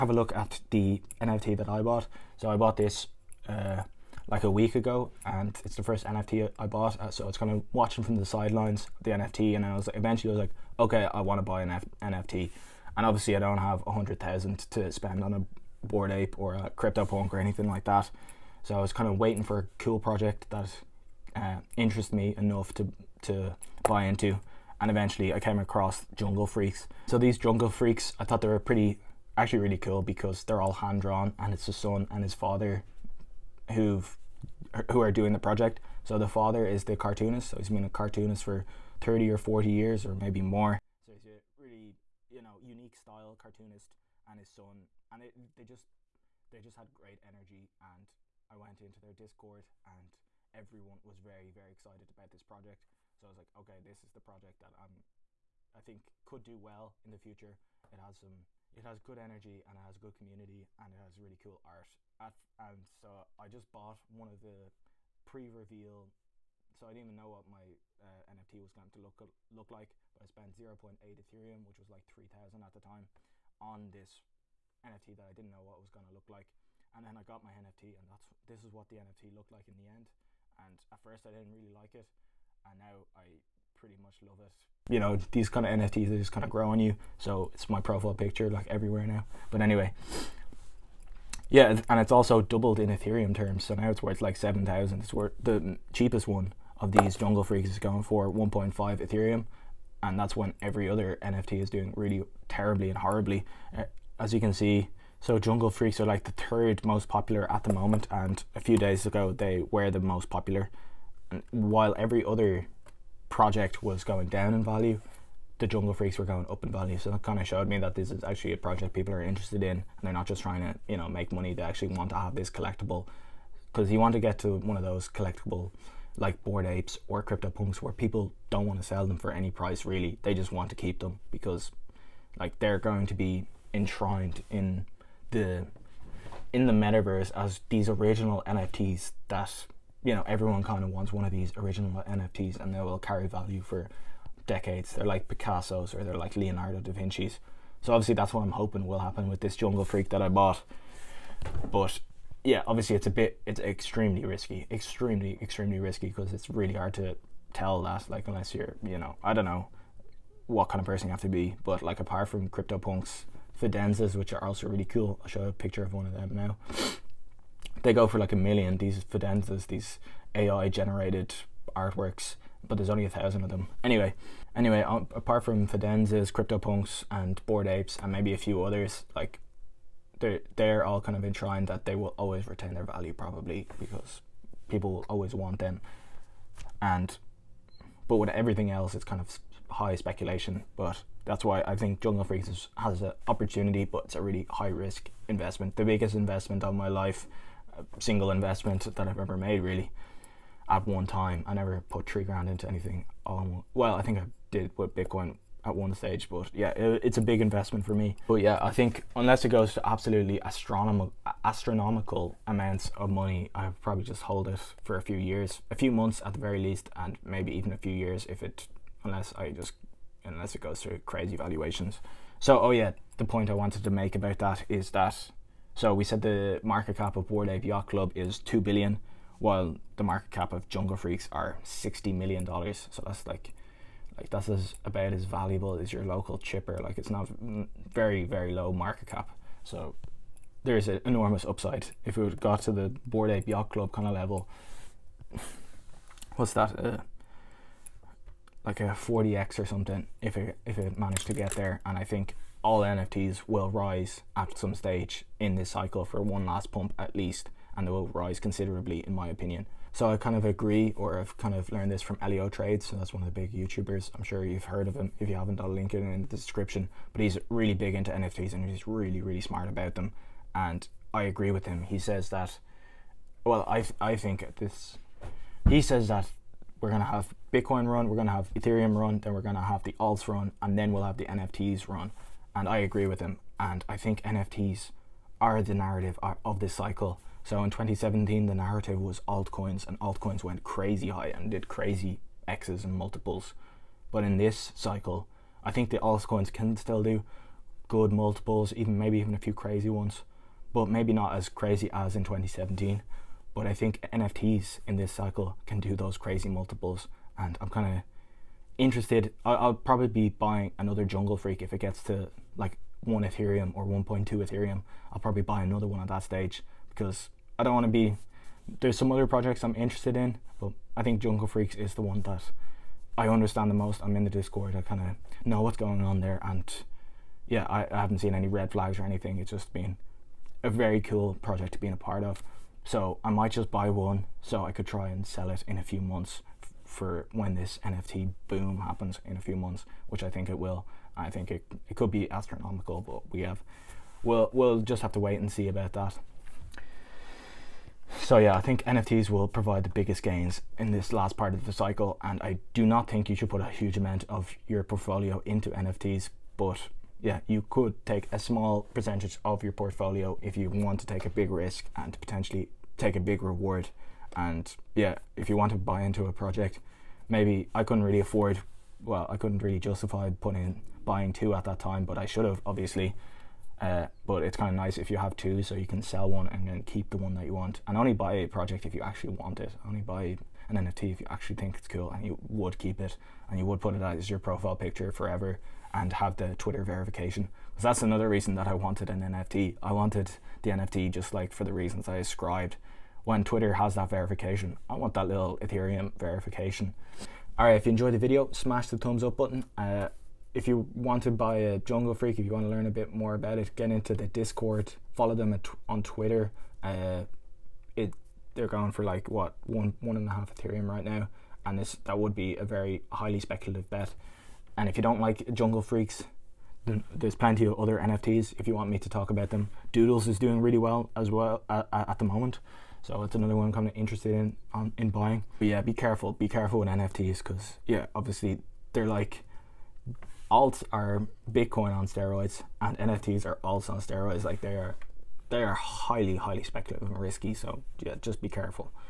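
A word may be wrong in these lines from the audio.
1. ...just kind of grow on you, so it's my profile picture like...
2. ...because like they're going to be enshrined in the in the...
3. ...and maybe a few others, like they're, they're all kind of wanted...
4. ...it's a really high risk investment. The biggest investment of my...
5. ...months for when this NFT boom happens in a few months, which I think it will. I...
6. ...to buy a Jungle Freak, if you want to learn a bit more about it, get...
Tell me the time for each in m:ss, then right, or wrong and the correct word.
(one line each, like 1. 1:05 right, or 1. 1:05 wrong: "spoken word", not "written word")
1. 1:26 right
2. 2:11 right
3. 2:58 wrong: "enshrined", not "wanted"
4. 3:14 right
5. 5:36 right
6. 6:41 right.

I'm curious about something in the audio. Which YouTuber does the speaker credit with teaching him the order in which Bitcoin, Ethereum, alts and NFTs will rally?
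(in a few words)
Elio Trades.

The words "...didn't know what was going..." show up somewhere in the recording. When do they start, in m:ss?
1:15.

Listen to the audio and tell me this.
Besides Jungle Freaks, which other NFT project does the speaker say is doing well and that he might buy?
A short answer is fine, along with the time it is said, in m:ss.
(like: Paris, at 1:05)
Doodles, at 6:59.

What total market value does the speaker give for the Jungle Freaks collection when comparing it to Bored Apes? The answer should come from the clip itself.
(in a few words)
$60 million.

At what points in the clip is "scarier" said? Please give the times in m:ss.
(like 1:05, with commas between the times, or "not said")
not said.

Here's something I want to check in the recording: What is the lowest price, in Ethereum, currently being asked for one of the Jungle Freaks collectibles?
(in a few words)
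1.5 Ethereum.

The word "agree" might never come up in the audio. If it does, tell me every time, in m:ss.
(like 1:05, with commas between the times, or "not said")
4:20, 4:31, 4:42.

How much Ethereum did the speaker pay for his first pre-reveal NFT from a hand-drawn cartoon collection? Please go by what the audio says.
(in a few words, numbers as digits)
0.8 Ethereum.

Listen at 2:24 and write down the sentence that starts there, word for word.
They're like Picasso's or they're like Leonardo da Vinci's.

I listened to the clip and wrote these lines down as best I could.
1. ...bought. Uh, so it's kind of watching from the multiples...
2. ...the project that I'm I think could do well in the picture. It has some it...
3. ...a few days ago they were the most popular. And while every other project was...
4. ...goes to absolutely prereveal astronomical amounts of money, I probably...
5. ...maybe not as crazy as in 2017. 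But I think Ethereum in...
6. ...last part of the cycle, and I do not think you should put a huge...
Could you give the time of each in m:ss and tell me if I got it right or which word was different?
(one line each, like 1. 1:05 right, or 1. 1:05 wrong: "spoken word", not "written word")
1. 0:06 wrong: "sidelines", not "multiples"
2. 0:54 wrong: "future", not "picture"
3. 1:48 right
4. 3:29 wrong: "astronomical", not "prereveal"
5. 5:00 wrong: "NFTs", not "Ethereum"
6. 5:51 right.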